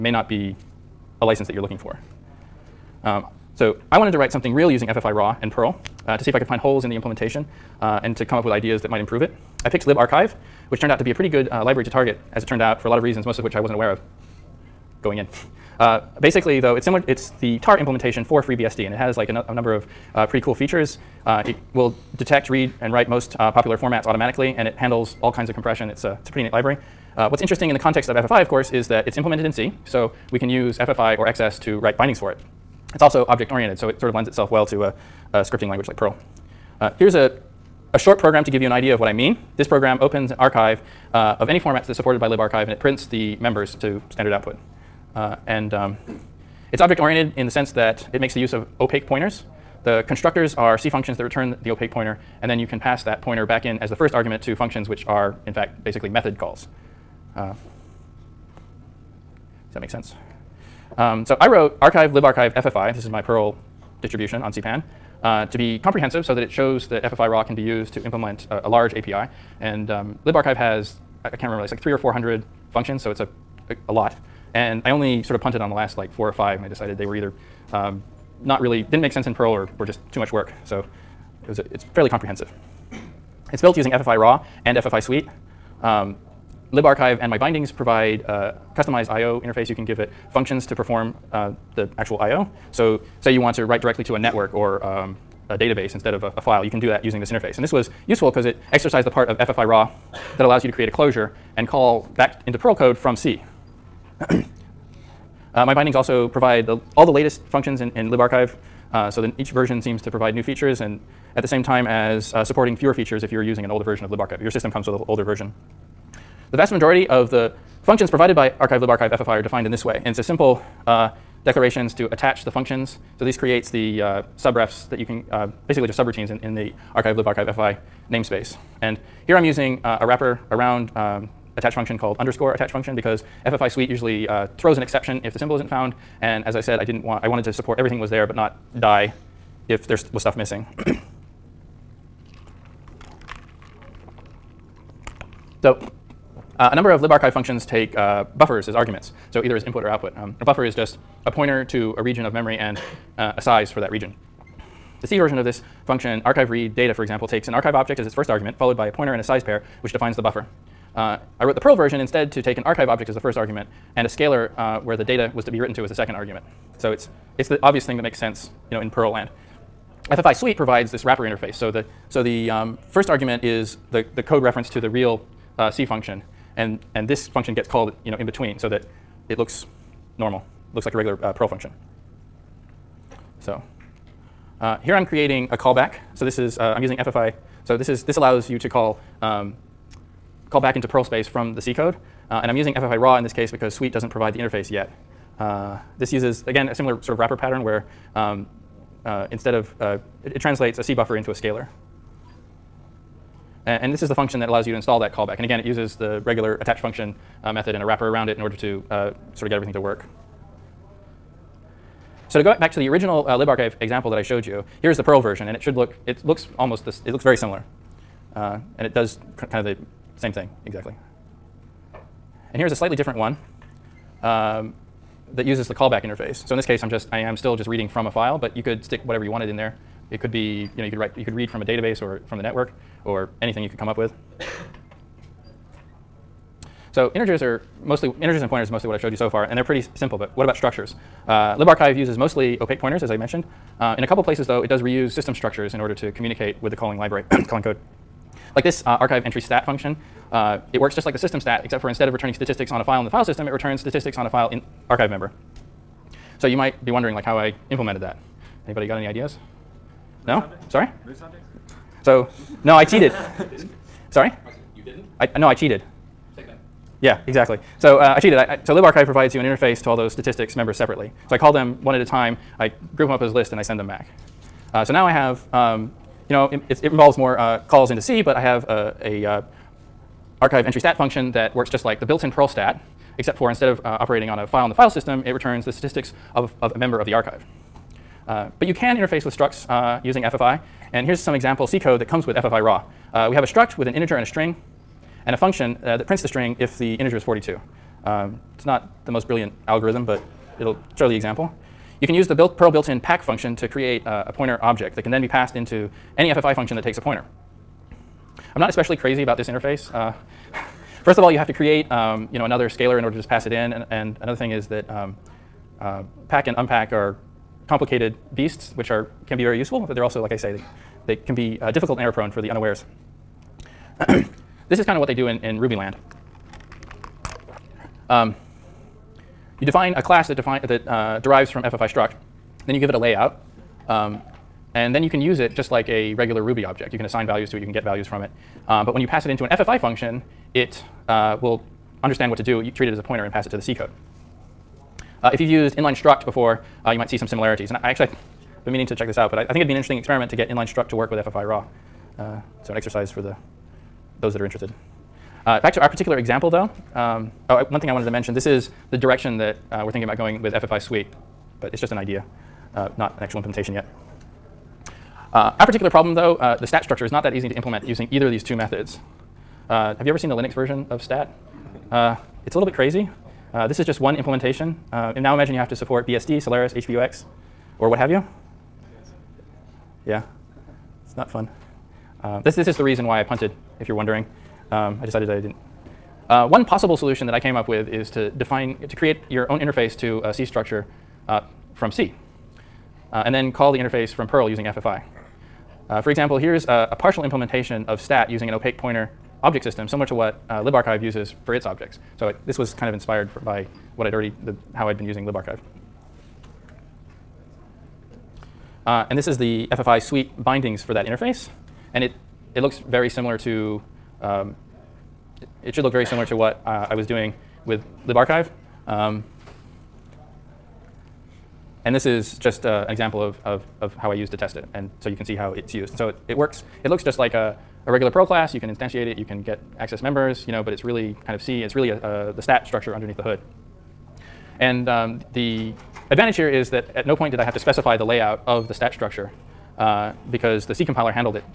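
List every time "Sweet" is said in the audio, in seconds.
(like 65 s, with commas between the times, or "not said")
85 s, 133 s, 170 s, 193 s, 360 s, 410 s.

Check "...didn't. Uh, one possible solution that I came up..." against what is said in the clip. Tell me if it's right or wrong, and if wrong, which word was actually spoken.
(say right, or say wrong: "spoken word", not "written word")
right.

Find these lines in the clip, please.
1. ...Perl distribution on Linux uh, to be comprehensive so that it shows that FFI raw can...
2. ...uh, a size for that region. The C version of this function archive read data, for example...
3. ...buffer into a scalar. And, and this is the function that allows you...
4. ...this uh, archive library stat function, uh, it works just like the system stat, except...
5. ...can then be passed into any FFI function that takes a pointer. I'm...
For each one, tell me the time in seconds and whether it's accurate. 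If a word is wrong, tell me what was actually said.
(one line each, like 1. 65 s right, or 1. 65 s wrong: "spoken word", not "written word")
1. 63 s wrong: "CPAN", not "Linux"
2. 153 s right
3. 200 s right
4. 248 s wrong: "entry", not "library"
5. 305 s right.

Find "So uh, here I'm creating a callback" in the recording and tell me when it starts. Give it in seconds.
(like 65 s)
183 s.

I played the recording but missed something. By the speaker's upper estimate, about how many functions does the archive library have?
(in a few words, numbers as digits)
400.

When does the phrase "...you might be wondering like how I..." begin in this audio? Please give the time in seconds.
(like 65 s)
256 s.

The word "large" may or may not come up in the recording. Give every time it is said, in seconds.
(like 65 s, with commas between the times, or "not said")
68 s.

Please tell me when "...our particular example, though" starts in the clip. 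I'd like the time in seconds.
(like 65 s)
355 s.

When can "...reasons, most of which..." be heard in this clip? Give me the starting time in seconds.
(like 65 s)
13 s.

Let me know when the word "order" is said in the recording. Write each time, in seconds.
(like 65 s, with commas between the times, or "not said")
208 s, 245 s, 313 s.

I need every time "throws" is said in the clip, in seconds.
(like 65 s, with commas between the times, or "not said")
134 s.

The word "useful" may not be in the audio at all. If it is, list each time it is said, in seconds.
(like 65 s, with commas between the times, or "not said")
98 s, 319 s.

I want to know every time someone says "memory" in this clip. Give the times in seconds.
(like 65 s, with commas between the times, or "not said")
152 s.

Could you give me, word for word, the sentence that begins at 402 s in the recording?
So it, this was kind of inspired for, by what I'd already, the, how I'd been using libarchive.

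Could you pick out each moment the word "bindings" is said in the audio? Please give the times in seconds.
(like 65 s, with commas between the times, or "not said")
31 s, 87 s, 105 s, 410 s.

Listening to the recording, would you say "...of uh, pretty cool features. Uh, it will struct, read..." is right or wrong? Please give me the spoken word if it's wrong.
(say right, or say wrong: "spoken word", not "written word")
wrong: "detect", not "struct".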